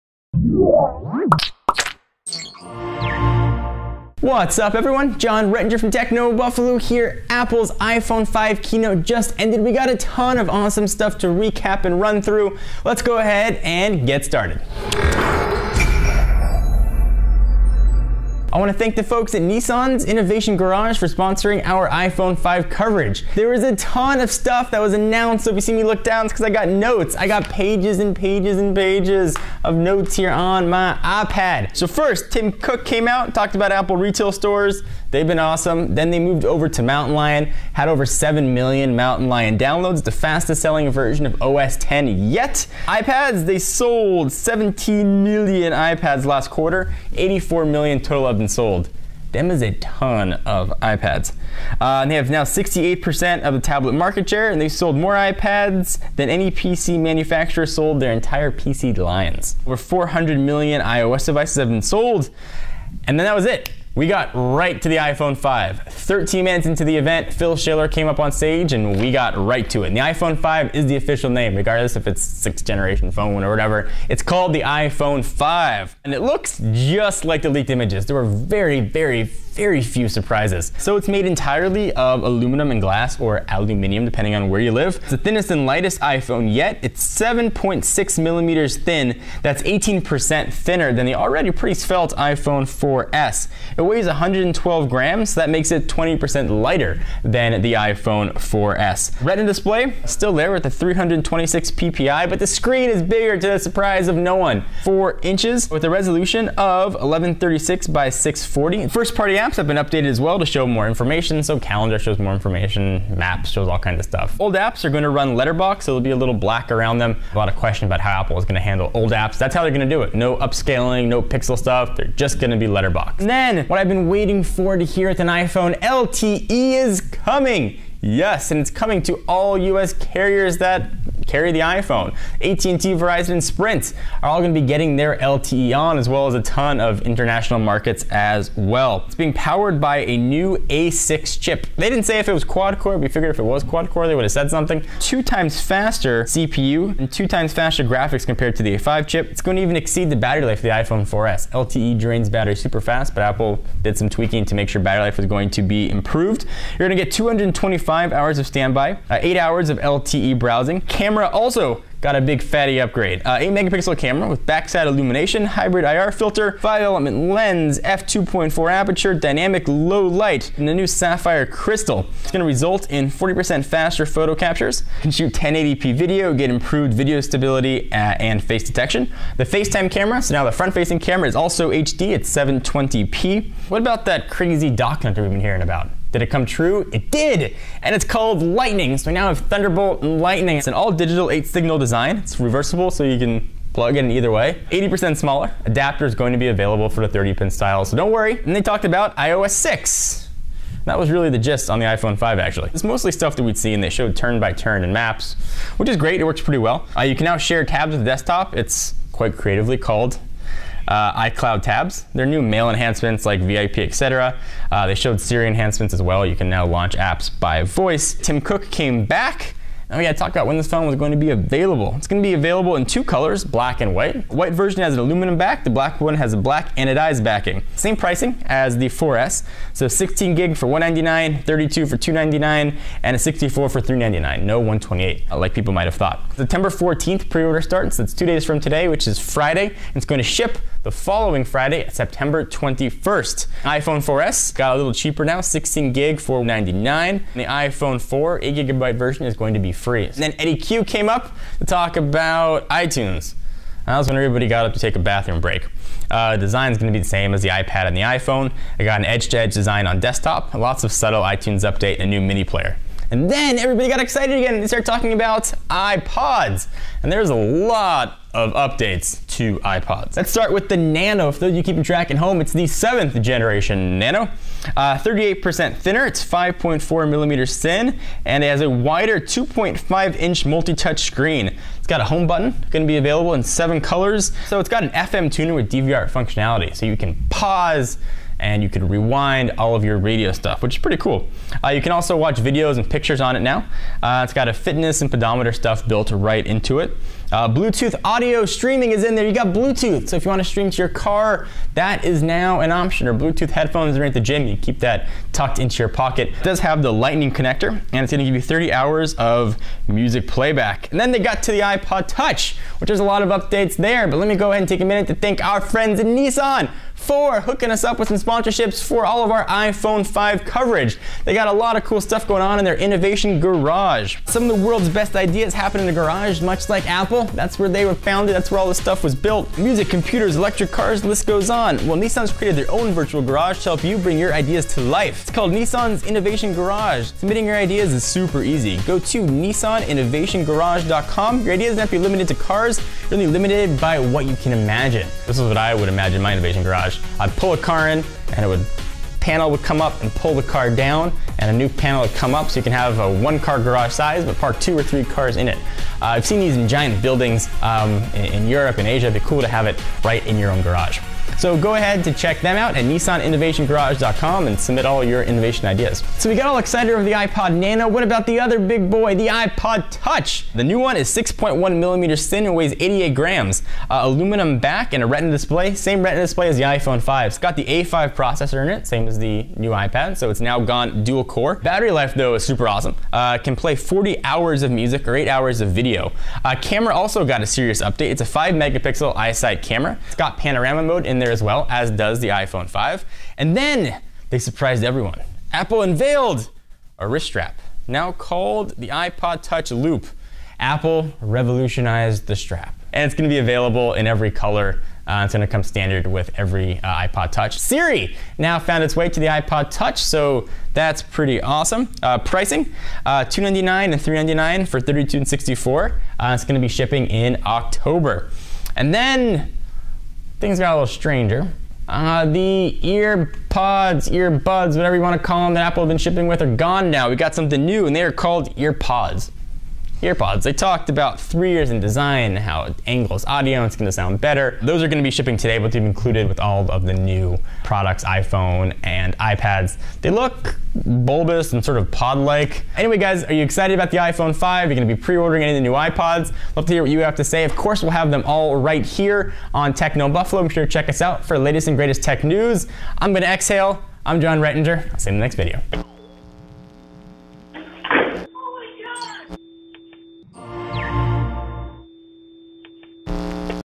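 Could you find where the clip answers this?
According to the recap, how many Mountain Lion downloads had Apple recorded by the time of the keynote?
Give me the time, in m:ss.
0:37.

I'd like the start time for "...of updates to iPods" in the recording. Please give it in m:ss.
4:28.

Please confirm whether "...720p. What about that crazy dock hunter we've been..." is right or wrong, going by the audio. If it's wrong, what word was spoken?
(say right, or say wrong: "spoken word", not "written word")
right.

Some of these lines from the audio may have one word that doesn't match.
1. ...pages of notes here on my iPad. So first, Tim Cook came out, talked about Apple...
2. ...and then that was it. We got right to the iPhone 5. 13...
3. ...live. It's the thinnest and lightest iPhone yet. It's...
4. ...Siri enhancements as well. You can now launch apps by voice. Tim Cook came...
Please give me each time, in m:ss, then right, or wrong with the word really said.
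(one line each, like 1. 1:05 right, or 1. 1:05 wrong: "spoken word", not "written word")
1. 0:28 right
2. 1:03 right
3. 1:24 right
4. 3:35 right.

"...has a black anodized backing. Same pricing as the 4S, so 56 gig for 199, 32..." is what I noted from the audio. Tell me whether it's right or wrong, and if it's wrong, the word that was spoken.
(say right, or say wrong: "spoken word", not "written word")
wrong: "16", not "56".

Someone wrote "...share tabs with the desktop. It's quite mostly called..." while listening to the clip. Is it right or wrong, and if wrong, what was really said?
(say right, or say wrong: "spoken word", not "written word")
wrong: "creatively", not "mostly".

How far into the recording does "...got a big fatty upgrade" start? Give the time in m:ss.
2:42.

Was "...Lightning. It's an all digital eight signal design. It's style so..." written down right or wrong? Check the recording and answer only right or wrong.
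wrong.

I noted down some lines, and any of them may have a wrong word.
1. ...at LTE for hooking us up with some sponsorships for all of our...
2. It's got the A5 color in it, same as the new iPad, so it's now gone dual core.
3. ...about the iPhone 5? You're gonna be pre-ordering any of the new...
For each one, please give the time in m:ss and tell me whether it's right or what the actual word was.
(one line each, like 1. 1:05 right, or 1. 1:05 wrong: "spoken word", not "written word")
1. 5:16 wrong: "Nissan", not "LTE"
2. 6:17 wrong: "processor", not "color"
3. 7:23 right.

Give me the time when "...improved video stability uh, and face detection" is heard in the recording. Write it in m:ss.
2:56.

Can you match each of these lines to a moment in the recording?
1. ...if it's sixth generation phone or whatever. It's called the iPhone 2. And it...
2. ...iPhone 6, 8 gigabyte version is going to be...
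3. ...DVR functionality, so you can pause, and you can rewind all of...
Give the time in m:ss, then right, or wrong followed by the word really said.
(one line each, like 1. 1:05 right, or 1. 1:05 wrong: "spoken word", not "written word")
1. 1:11 wrong: "5", not "2"
2. 4:07 wrong: "4", not "6"
3. 4:45 right.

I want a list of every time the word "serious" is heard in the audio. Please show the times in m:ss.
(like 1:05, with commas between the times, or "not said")
6:27.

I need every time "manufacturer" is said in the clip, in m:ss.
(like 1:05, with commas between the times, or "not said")
0:56.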